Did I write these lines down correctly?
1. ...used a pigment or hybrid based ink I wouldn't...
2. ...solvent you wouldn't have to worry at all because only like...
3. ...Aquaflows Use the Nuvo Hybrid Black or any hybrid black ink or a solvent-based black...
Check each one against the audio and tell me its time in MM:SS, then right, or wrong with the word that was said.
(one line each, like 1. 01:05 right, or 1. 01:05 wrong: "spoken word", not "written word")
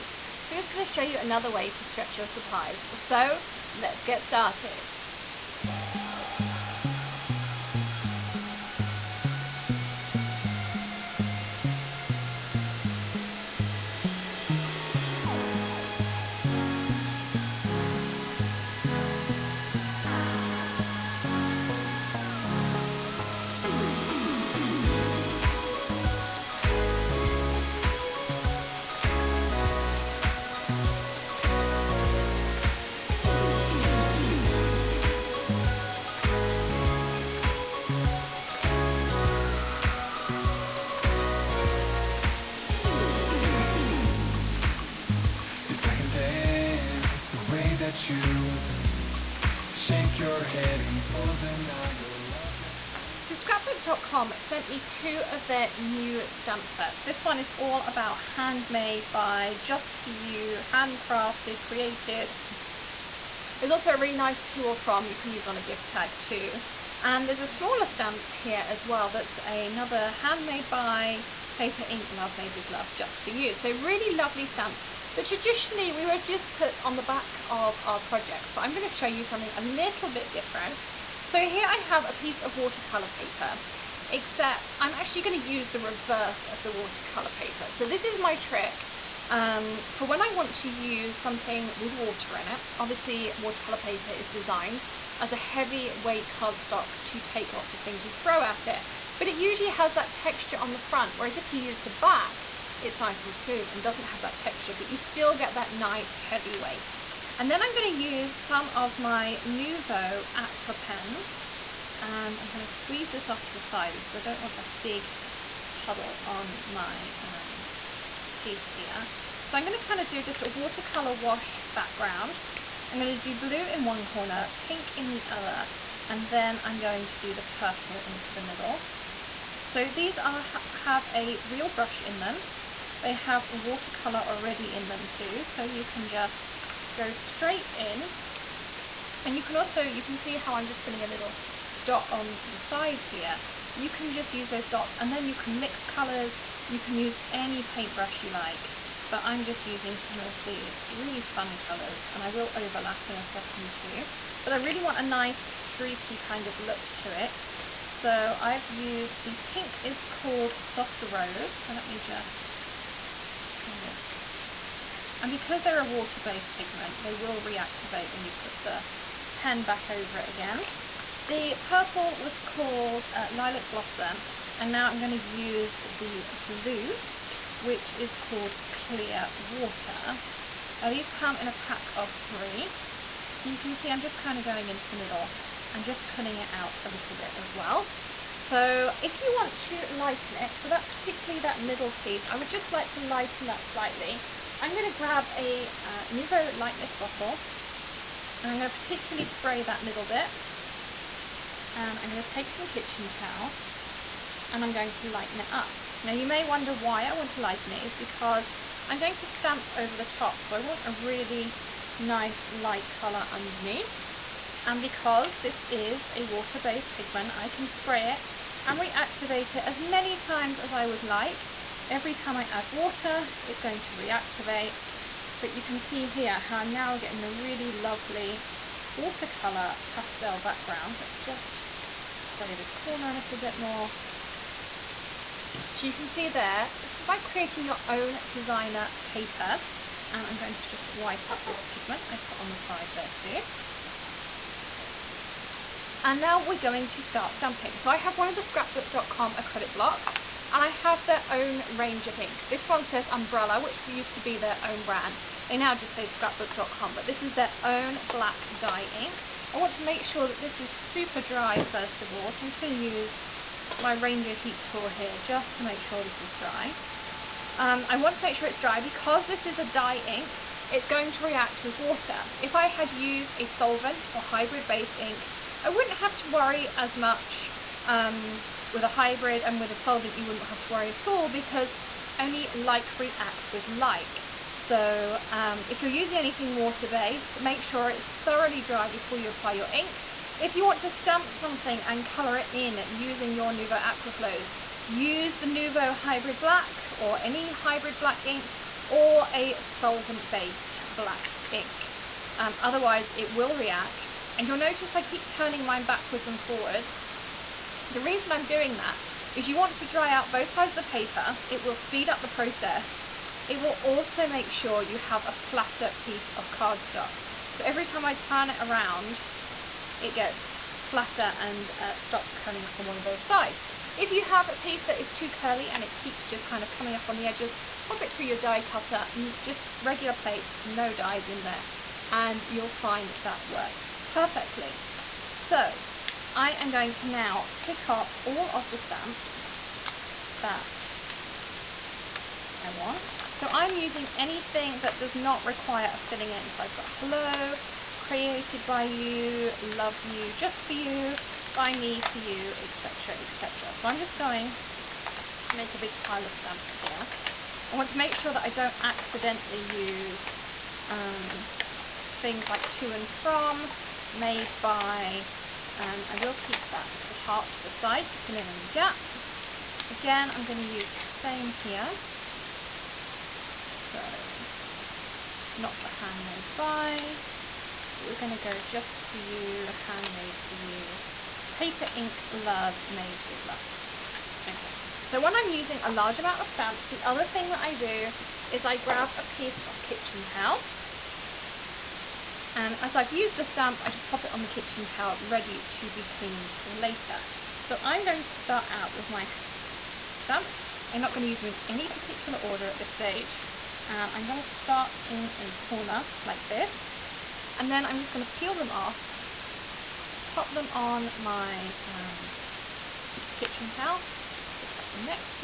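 1. 04:32 wrong: "solvent", not "pigment"
2. 04:39 right
3. 04:53 right.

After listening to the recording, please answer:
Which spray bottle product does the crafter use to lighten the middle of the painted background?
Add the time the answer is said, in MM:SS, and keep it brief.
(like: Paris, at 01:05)
Nuvo Light Mist, at 03:16.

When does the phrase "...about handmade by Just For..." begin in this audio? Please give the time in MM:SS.
00:57.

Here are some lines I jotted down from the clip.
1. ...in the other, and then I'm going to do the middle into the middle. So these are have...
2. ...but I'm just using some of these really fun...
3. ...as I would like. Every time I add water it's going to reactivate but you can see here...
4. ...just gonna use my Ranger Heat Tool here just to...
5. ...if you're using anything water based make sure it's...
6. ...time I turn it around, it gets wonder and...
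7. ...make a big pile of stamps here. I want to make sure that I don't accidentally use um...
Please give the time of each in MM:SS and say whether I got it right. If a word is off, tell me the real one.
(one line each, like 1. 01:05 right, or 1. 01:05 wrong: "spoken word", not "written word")
1. 02:04 wrong: "purple", not "middle"
2. 02:29 right
3. 03:40 right
4. 04:22 right
5. 04:45 right
6. 05:17 wrong: "flatter", not "wonder"
7. 05:55 right.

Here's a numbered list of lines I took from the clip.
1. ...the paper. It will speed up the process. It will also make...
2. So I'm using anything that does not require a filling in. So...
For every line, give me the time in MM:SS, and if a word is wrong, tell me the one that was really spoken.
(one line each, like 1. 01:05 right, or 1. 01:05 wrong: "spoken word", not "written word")
1. 05:10 right
2. 05:43 right.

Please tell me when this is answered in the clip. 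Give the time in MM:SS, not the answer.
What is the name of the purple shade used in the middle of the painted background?
02:53.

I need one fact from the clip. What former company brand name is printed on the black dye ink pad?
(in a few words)
Umbrella.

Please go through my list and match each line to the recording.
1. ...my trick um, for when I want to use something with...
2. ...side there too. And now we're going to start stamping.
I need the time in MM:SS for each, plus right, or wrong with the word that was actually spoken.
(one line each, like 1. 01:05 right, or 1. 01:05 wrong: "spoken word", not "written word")
1. 01:28 right
2. 04:02 right.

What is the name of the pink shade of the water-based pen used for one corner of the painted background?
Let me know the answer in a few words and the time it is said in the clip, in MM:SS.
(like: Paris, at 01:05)
Soft Rose, at 02:40.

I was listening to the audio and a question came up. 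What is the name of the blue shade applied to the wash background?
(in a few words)
Clear Water.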